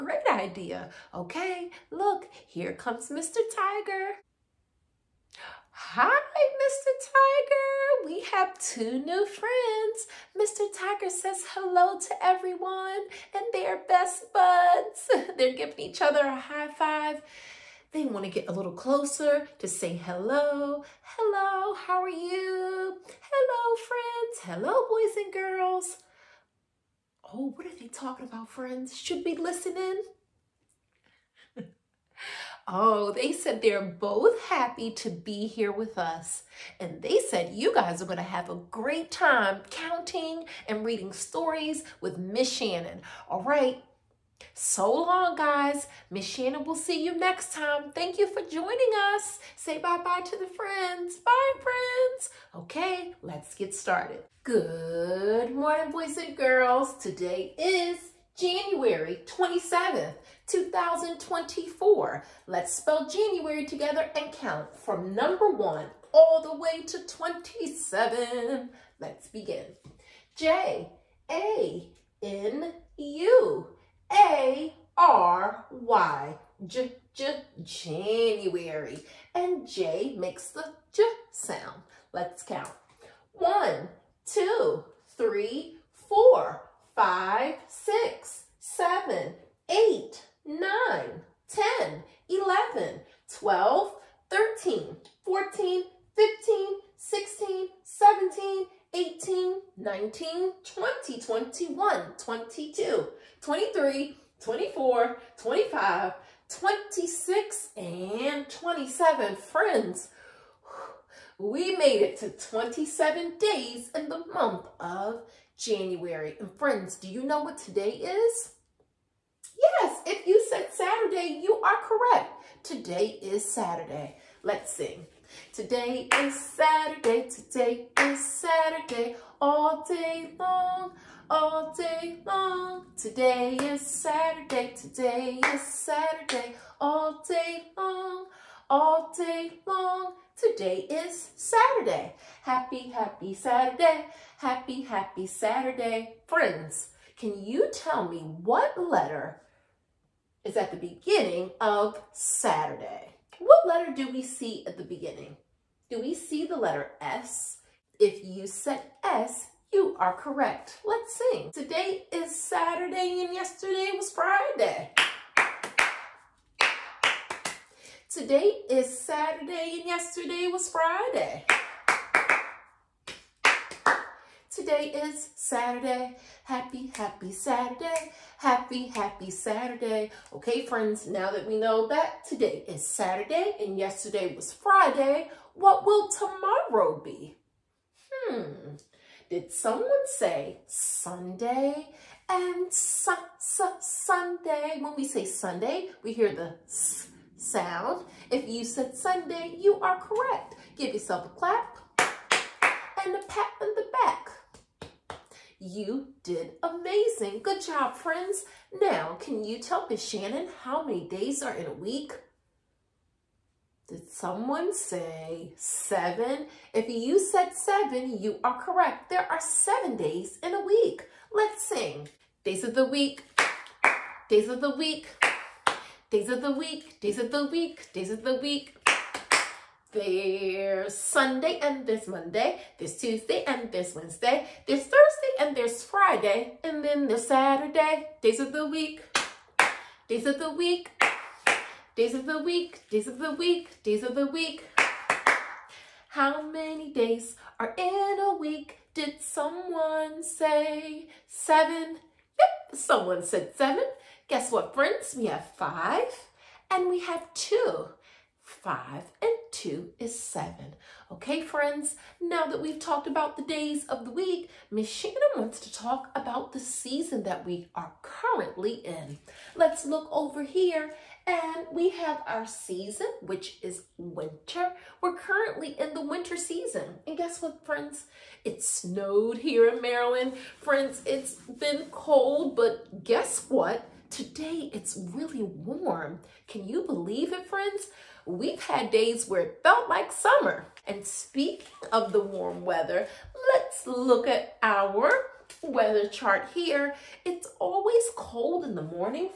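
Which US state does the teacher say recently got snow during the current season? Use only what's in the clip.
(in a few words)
Maryland.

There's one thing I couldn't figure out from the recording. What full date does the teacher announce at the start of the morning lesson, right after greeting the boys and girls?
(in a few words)
January 27th, 2024.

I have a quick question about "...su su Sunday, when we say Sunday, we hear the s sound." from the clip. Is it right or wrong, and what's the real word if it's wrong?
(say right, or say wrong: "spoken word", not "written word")
right.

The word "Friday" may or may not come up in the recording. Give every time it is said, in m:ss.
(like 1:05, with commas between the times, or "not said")
2:44, 2:50, 3:04, 3:55.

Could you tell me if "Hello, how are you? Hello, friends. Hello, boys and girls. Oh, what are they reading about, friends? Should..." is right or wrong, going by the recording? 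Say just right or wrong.
wrong.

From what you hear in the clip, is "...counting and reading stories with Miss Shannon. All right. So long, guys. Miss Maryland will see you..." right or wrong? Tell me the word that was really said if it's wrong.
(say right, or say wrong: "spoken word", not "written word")
wrong: "Shannon", not "Maryland".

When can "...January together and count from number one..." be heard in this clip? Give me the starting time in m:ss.
1:03.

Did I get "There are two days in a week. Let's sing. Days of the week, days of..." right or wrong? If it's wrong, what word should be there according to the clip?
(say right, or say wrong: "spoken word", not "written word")
wrong: "seven", not "two".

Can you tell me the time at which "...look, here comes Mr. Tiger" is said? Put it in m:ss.
0:01.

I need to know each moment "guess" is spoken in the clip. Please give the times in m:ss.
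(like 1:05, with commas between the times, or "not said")
4:14, 4:37, 4:43.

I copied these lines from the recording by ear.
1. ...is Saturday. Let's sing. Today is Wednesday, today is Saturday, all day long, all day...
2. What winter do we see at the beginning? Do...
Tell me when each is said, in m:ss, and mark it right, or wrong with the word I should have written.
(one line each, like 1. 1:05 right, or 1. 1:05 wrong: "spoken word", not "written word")
1. 2:03 wrong: "Saturday", not "Wednesday"
2. 2:33 wrong: "letter", not "winter".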